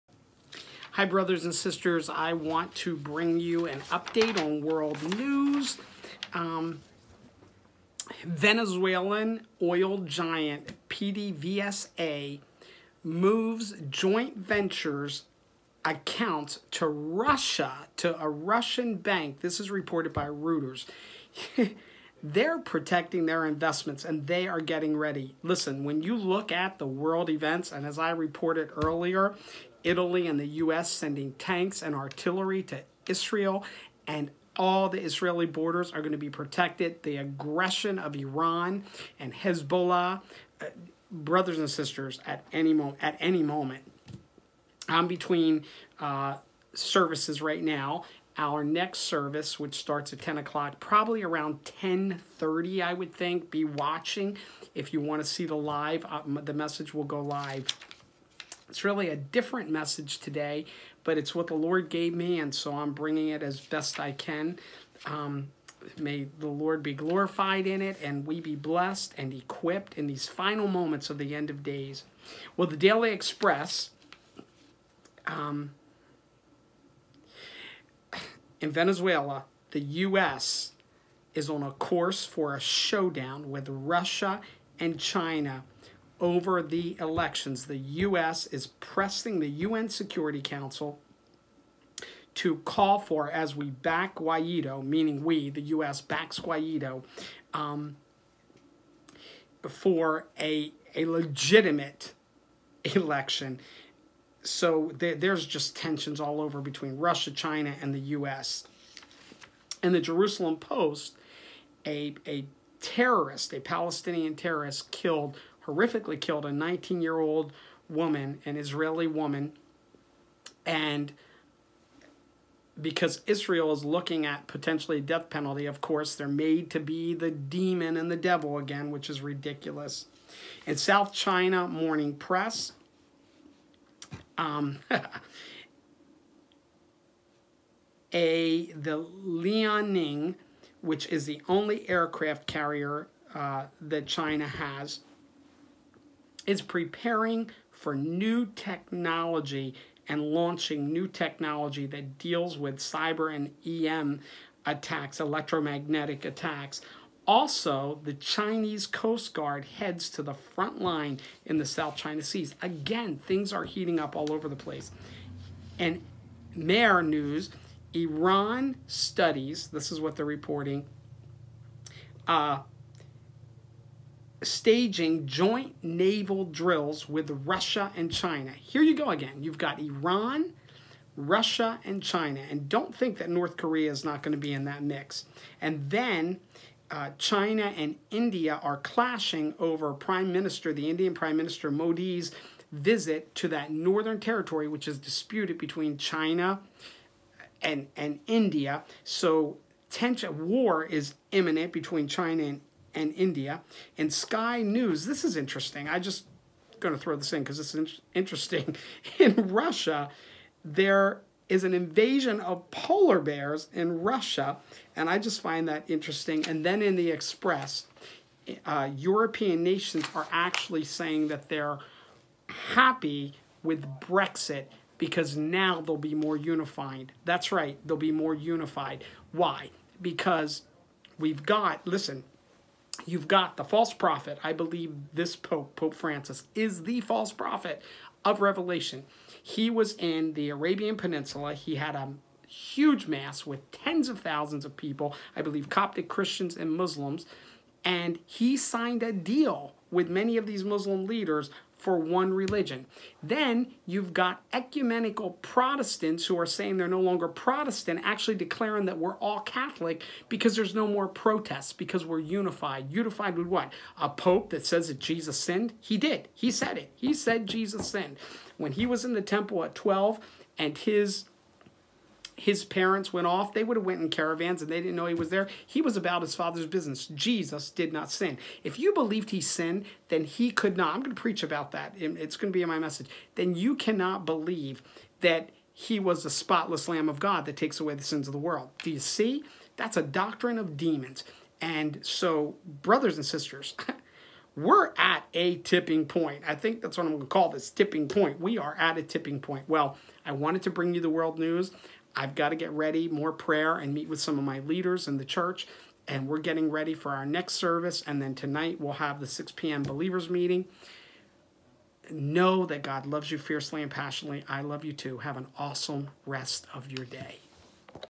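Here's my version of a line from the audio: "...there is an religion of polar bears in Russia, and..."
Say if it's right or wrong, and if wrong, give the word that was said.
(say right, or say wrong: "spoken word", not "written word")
wrong: "invasion", not "religion".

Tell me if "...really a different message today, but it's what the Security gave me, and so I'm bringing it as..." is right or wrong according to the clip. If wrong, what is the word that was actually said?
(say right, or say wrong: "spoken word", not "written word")
wrong: "Lord", not "Security".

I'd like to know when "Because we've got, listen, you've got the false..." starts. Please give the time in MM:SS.
03:50.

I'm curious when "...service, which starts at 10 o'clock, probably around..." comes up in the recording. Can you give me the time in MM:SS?
00:48.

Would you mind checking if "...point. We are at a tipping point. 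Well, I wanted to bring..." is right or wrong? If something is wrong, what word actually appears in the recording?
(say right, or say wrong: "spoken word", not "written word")
right.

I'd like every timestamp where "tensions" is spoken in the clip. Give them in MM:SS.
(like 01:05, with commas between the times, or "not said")
01:45, 03:19.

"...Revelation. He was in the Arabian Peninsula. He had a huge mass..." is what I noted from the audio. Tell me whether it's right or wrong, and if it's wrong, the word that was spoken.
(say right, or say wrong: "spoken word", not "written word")
right.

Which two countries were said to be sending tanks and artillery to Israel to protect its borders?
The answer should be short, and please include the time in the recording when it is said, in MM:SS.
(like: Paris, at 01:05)
Italy and the U.S., at 00:29.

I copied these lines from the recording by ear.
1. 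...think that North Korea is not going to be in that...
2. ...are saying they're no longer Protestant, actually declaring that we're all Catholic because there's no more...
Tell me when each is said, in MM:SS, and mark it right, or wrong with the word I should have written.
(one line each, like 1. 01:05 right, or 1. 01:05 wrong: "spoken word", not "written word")
1. 03:02 right
2. 04:16 right.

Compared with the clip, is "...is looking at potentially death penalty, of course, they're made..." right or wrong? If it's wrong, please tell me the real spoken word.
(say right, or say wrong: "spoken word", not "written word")
right.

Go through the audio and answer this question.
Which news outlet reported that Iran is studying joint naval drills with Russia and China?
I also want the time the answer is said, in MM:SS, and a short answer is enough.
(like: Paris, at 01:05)
Mehr News, at 02:46.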